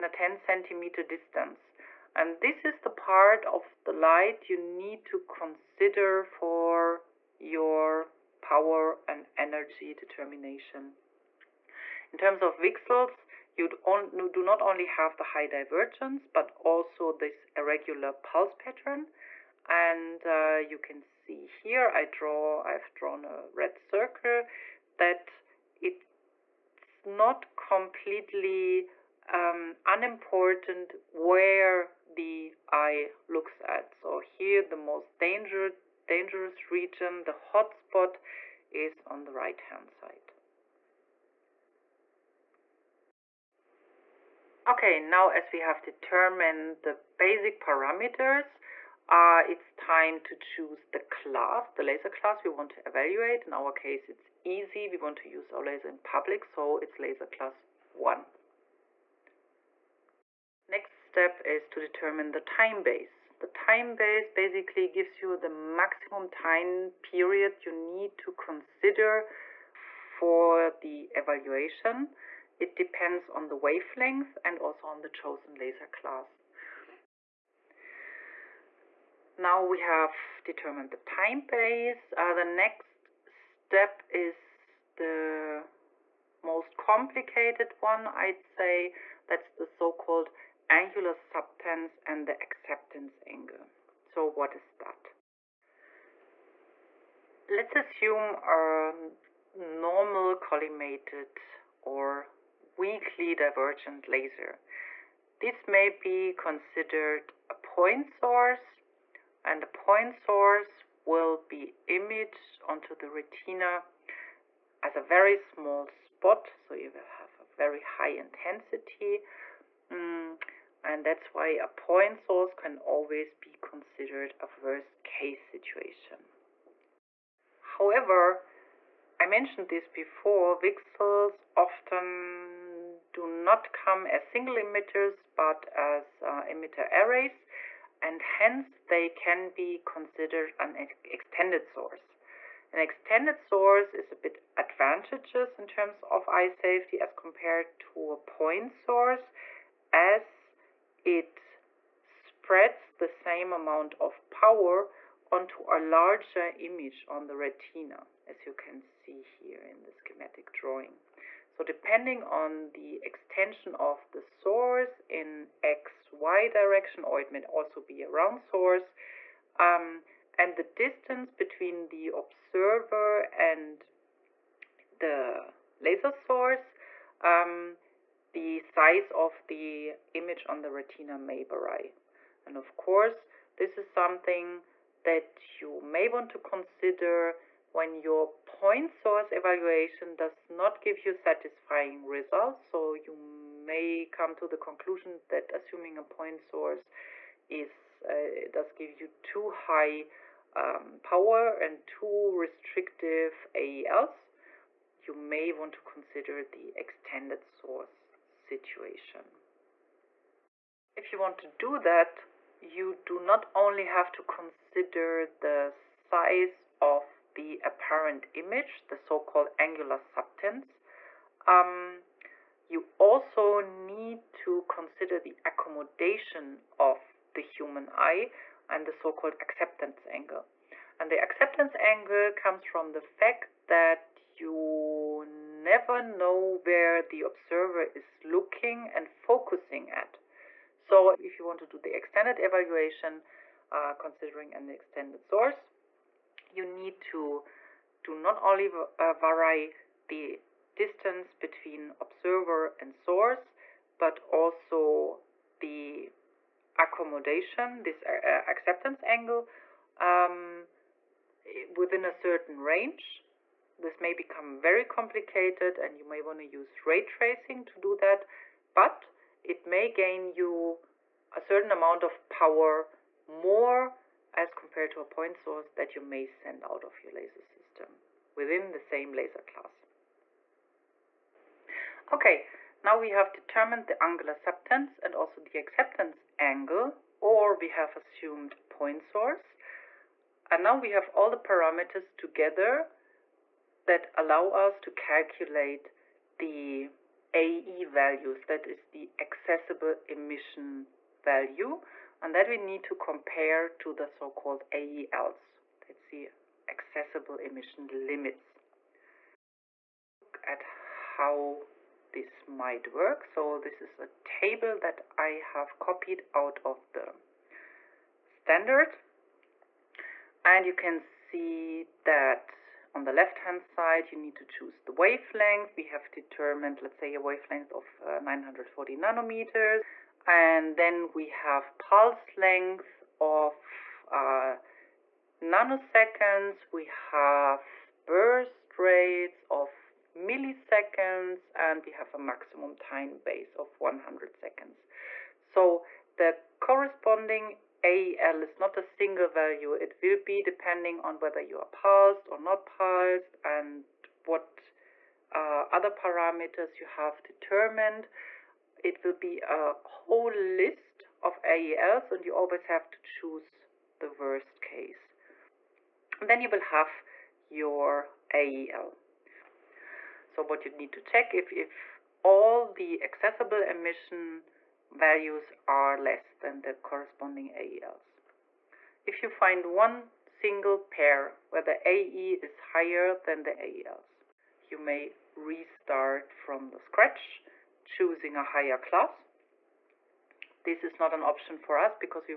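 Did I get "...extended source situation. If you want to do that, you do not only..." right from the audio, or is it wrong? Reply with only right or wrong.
right.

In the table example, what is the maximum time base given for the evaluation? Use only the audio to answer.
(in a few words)
100 seconds.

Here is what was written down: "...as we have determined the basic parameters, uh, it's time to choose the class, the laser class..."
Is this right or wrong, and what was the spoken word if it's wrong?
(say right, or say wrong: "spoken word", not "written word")
right.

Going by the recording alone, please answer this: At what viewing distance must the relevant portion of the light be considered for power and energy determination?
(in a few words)
10 centimeters.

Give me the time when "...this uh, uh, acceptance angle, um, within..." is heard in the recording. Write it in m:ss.
4:17.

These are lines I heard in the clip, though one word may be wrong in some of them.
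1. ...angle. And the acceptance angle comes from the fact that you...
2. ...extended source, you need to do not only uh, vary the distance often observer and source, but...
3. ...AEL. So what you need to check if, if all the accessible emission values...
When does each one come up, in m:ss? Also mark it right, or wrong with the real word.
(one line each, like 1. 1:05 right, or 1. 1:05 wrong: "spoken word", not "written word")
1. 3:50 right
2. 4:04 wrong: "between", not "often"
3. 6:08 right.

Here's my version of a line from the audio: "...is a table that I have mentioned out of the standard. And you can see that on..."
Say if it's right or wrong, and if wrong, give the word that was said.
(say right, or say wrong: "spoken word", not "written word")
wrong: "copied", not "mentioned".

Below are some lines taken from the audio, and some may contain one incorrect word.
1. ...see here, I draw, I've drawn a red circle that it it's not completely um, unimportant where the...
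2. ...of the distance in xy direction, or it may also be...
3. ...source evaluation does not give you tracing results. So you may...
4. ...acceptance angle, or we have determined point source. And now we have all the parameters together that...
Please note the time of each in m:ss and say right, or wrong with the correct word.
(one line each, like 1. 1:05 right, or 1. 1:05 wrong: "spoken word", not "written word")
1. 0:21 right
2. 2:43 wrong: "source", not "distance"
3. 3:08 wrong: "satisfying", not "tracing"
4. 4:45 wrong: "assumed", not "determined".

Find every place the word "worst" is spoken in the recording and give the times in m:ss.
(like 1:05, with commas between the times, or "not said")
2:04, 6:04.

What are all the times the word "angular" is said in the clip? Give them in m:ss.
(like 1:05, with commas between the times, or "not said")
1:30, 3:39, 4:44.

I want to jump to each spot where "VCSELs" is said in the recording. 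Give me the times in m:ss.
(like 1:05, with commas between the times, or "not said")
0:12, 2:10.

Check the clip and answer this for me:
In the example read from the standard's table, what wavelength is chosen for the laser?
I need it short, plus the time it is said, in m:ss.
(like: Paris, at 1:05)
940 nanometers, at 5:28.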